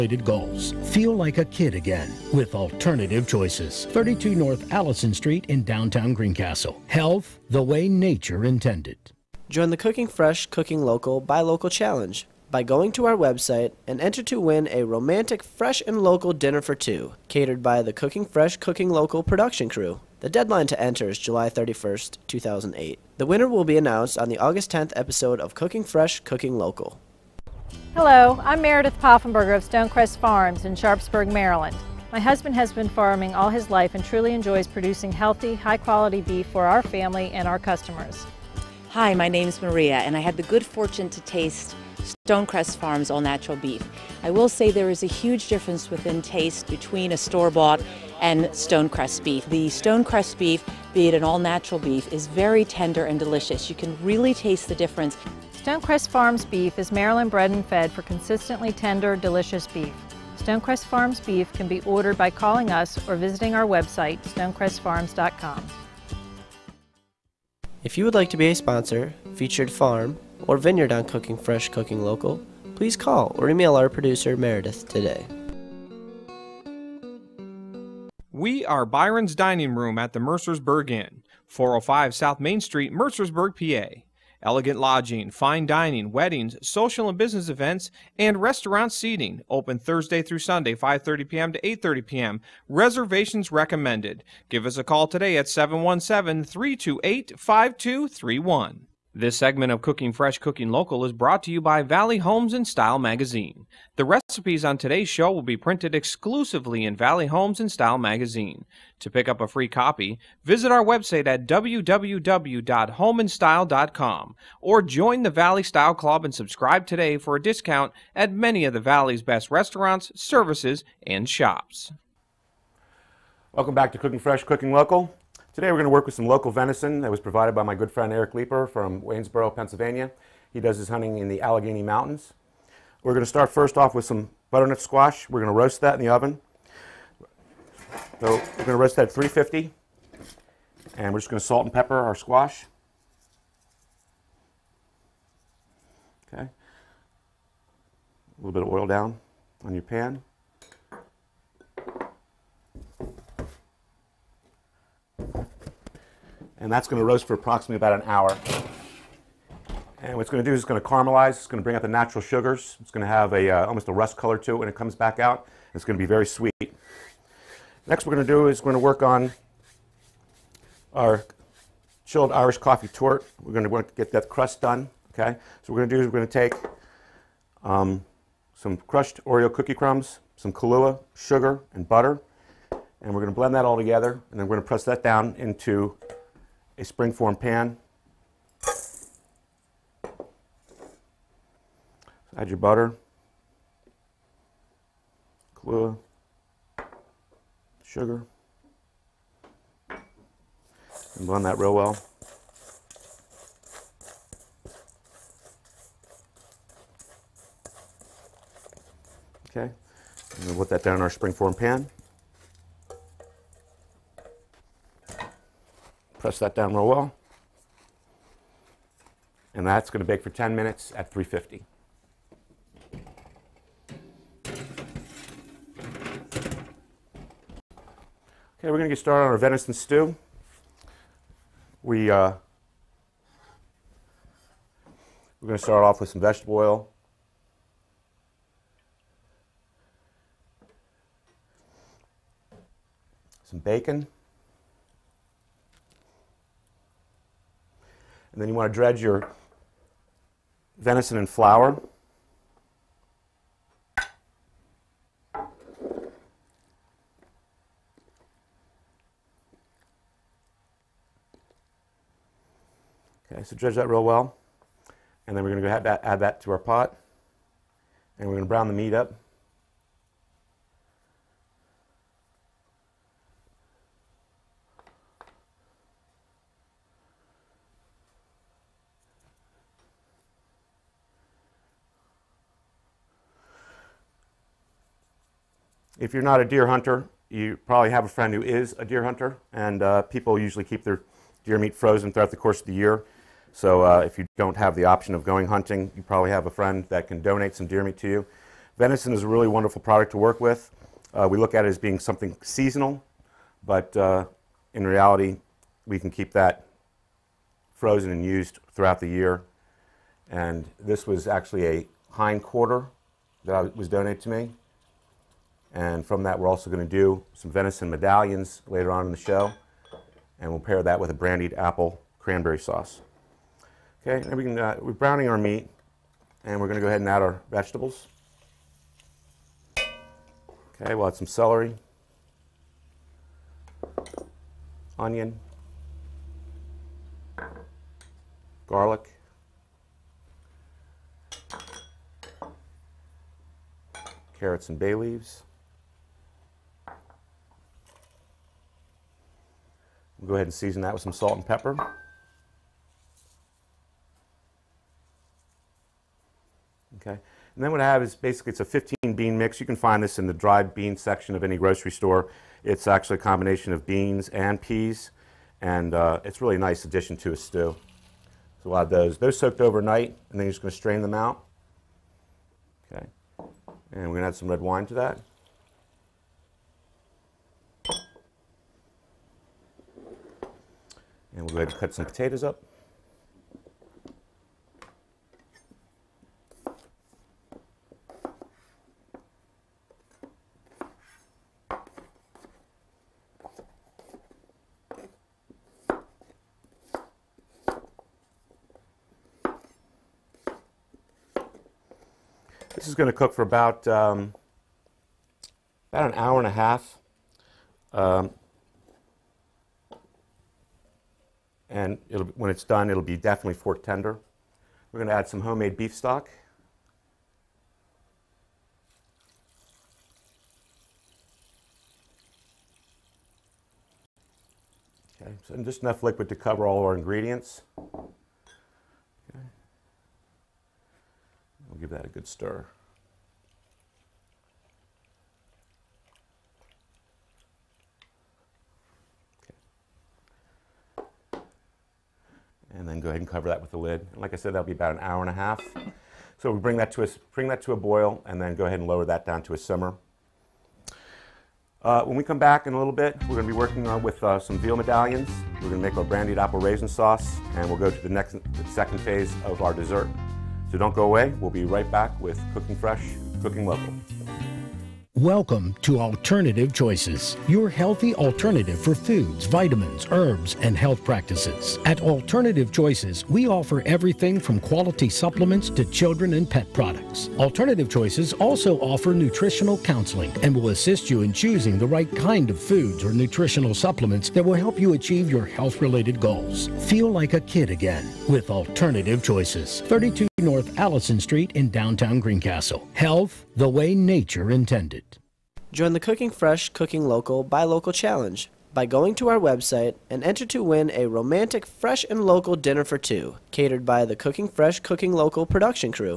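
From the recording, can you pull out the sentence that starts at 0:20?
The deadline to enter is July 31st, 2008.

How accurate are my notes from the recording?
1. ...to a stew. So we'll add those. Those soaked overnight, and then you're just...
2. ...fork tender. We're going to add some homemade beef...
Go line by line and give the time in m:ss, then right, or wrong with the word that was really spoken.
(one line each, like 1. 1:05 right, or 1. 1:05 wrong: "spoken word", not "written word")
1. 6:07 right
2. 6:53 right.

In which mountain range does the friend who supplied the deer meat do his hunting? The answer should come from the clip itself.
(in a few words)
Allegheny Mountains.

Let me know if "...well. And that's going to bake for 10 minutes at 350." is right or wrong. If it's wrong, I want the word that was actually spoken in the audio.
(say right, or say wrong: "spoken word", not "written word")
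right.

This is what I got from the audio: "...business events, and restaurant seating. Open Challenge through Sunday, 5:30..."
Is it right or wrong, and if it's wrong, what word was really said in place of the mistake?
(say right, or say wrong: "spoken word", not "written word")
wrong: "Thursday", not "Challenge".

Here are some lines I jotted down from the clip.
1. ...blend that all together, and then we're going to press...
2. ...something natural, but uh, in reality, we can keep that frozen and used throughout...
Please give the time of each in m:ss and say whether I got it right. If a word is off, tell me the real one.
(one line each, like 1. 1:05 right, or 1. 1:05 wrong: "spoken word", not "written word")
1. 3:03 right
2. 5:01 wrong: "seasonal", not "natural".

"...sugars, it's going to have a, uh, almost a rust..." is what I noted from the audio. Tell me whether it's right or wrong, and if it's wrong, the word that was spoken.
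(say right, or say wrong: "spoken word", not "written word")
right.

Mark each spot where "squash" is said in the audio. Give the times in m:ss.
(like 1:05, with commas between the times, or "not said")
2:14, 2:22.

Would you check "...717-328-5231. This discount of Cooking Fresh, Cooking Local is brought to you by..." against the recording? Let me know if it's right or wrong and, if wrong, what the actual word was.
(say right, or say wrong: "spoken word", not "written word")
wrong: "segment", not "discount".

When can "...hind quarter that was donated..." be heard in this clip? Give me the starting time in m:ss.
5:12.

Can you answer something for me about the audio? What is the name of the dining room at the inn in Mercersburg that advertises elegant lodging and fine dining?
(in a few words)
Byron's Dining Room.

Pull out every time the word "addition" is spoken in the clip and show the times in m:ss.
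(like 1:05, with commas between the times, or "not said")
6:06.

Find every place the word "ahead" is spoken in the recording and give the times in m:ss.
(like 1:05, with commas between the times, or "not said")
5:26, 5:50, 6:21, 7:23, 7:28.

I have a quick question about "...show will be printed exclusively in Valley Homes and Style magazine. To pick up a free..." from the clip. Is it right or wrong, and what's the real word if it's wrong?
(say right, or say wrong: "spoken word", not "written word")
right.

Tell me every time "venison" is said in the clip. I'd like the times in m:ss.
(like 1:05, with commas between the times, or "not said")
2:06, 3:49, 4:10, 4:58, 5:17.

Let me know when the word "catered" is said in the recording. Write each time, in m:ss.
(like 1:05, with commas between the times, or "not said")
0:17, 8:23.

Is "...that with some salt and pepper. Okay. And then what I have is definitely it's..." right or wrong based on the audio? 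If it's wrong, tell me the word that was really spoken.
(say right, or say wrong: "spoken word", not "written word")
wrong: "basically", not "definitely".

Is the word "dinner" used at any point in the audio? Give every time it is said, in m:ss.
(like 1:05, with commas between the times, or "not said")
0:16, 8:22.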